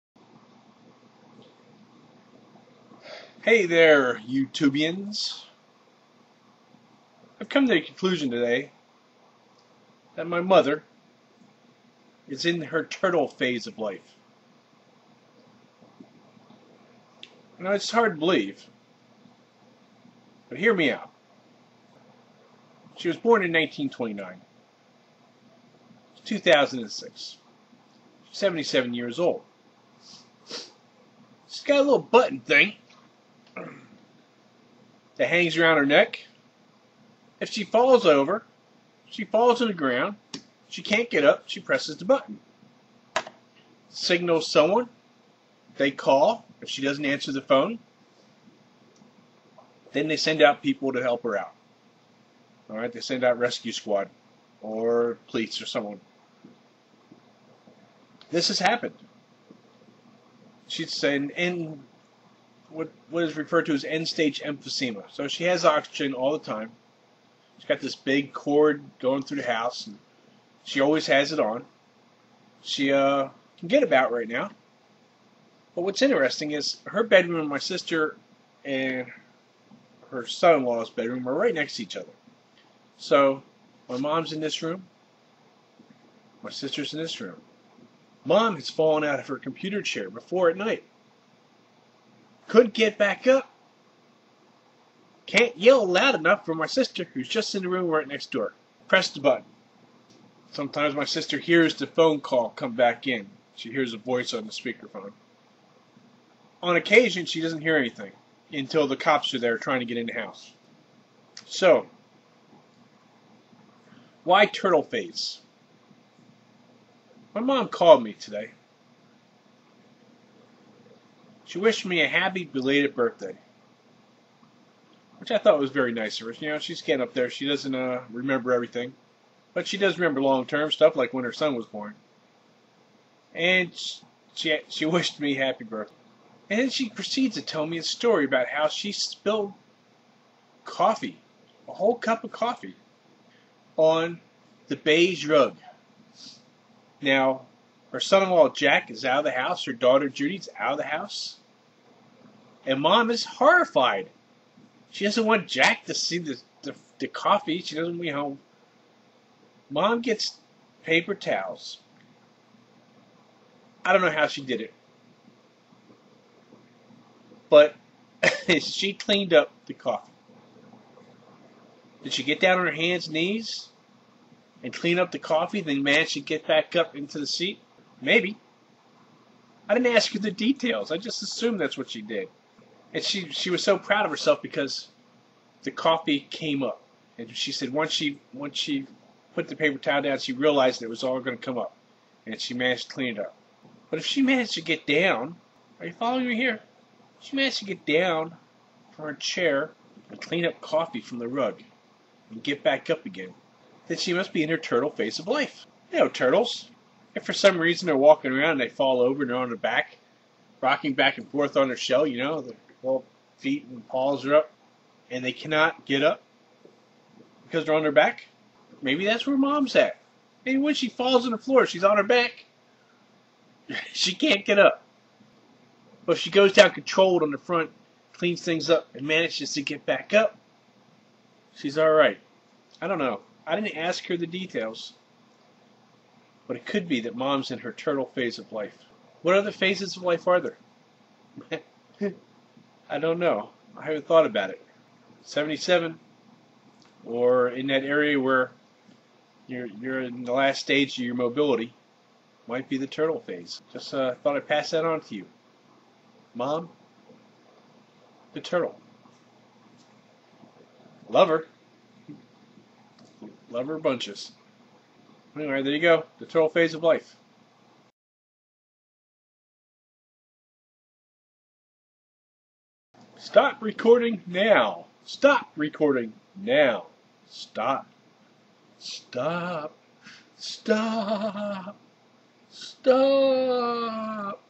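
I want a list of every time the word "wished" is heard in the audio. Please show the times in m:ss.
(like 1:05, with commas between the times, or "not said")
2:01, 2:14.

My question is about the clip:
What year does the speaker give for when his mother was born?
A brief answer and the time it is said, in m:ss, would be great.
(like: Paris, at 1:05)
1929, at 0:23.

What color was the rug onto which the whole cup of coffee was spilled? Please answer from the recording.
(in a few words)
Beige.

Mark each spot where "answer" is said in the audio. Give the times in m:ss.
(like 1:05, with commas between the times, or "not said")
0:47.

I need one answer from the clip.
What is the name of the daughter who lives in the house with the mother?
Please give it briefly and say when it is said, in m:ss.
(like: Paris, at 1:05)
Judy, at 2:30.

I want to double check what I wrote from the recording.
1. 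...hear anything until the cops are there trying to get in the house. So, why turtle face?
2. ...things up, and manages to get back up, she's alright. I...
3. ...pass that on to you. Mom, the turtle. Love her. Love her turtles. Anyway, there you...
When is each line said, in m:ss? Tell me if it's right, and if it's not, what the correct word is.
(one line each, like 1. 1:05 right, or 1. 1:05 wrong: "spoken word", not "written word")
1. 1:47 right
2. 3:48 right
3. 4:14 wrong: "bunches", not "turtles".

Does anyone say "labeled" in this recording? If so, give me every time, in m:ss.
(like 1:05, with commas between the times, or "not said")
not said.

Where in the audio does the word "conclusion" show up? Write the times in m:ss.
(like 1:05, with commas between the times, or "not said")
0:07.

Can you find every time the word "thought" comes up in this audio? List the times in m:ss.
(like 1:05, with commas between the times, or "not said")
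2:05, 4:04, 4:14.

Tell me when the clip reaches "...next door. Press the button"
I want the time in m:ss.
1:38.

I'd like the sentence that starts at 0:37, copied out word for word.
If she falls over, she falls to the ground.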